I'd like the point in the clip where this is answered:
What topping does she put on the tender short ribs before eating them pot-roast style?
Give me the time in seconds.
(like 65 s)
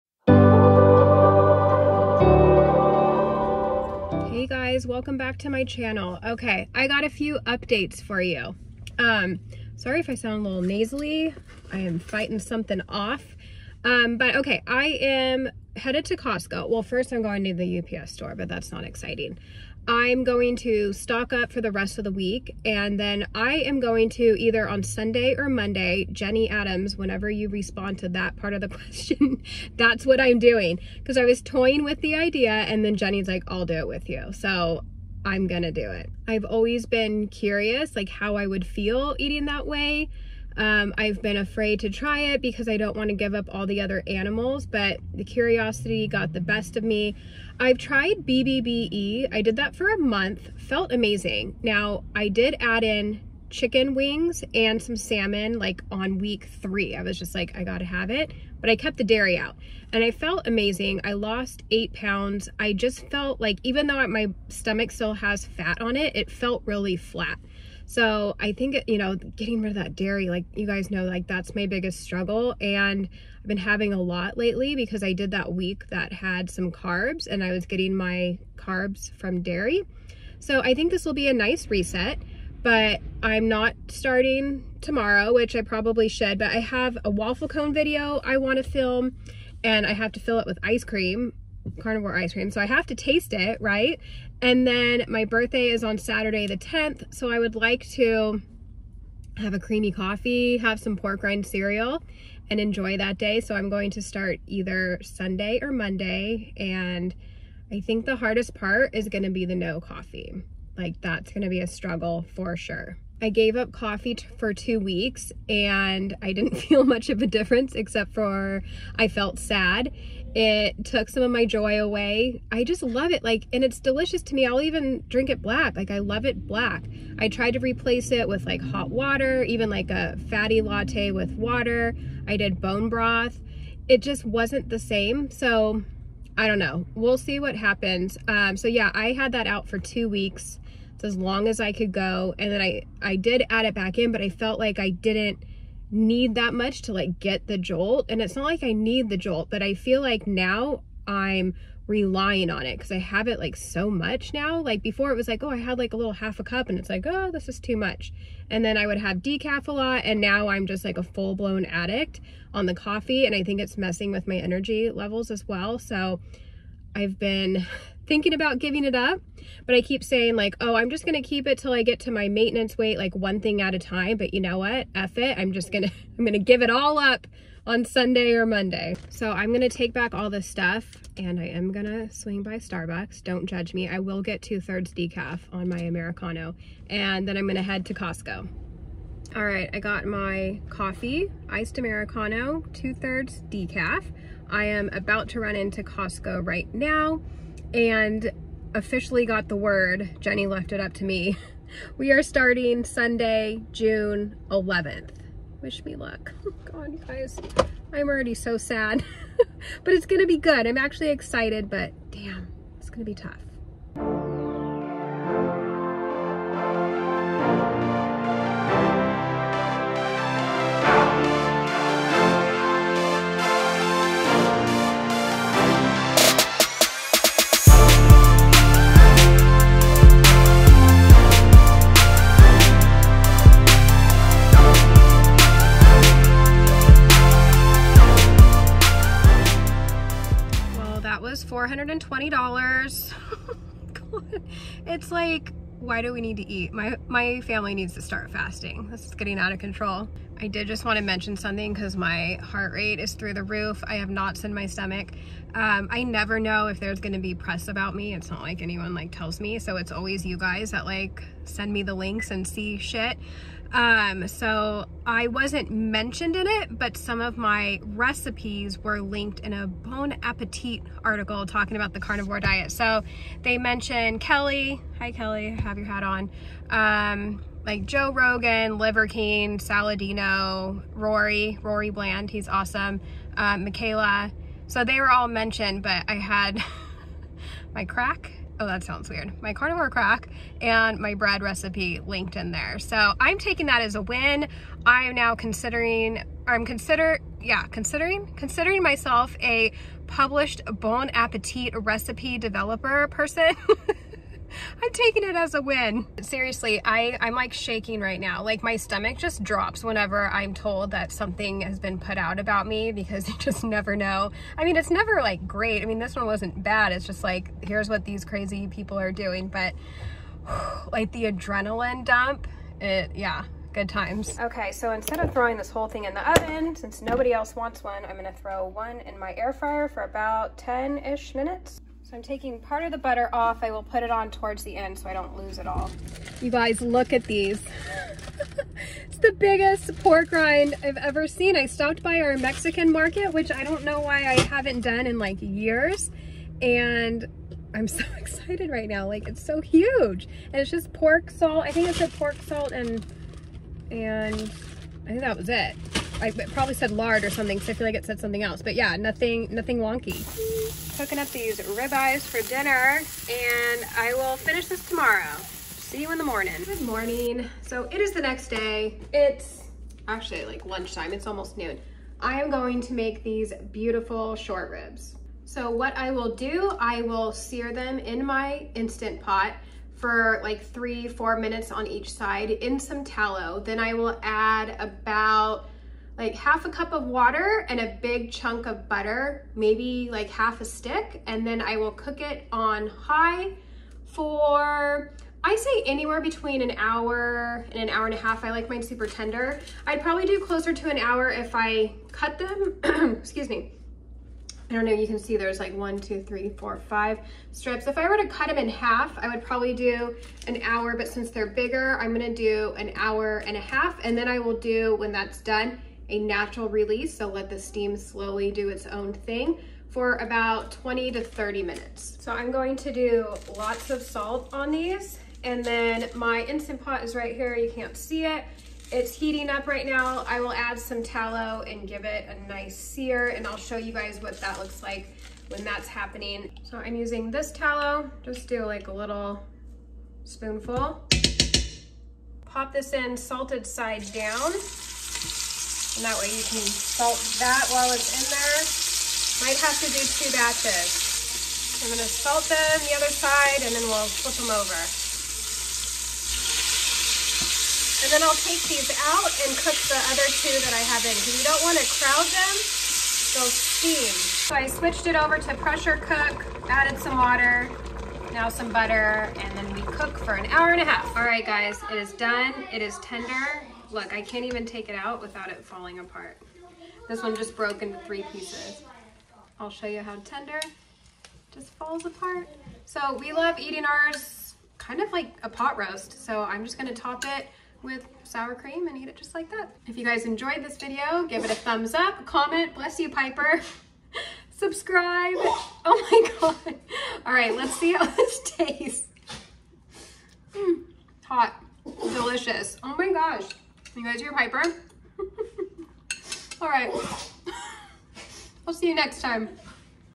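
488 s.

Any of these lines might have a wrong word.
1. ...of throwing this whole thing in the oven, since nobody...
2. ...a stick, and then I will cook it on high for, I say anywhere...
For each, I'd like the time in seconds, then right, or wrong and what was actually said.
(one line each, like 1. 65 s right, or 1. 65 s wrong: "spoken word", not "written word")
1. 325 s right
2. 390 s right.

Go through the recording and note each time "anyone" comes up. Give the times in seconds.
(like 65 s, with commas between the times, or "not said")
258 s.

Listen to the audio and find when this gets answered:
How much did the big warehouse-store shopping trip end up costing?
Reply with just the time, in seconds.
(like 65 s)
241 s.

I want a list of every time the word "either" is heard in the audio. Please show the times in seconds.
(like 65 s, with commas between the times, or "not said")
24 s, 104 s.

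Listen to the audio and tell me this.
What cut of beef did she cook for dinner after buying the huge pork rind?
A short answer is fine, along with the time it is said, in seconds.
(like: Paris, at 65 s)
ribeyes, at 361 s.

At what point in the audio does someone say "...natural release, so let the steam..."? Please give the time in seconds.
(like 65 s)
416 s.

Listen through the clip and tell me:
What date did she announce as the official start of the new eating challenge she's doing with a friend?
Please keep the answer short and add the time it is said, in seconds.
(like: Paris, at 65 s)
Sunday, June 11th, at 202 s.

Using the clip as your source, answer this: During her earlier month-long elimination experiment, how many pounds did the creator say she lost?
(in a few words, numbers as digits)
8.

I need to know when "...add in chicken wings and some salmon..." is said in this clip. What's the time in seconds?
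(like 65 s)
52 s.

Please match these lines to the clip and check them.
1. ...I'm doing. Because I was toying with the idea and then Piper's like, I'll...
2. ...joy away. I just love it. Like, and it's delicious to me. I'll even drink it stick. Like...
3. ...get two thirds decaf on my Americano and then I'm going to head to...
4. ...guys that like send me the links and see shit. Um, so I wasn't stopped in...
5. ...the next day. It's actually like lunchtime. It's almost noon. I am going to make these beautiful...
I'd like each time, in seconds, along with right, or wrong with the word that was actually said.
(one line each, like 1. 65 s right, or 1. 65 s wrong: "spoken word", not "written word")
1. 30 s wrong: "Jenny", not "Piper"
2. 121 s wrong: "black", not "stick"
3. 184 s right
4. 260 s wrong: "mentioned", not "stopped"
5. 368 s right.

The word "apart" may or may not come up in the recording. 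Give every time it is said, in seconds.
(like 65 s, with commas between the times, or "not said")
475 s, 482 s.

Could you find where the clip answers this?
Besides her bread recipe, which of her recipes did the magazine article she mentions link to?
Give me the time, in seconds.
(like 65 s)
289 s.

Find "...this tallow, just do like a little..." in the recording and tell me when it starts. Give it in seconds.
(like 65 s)
437 s.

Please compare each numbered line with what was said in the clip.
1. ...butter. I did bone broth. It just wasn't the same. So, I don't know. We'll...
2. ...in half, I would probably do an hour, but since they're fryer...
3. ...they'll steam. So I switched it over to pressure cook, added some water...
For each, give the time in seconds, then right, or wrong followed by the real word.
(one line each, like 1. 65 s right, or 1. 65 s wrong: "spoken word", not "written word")
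1. 131 s wrong: "water", not "butter"
2. 408 s wrong: "bigger", not "fryer"
3. 463 s right.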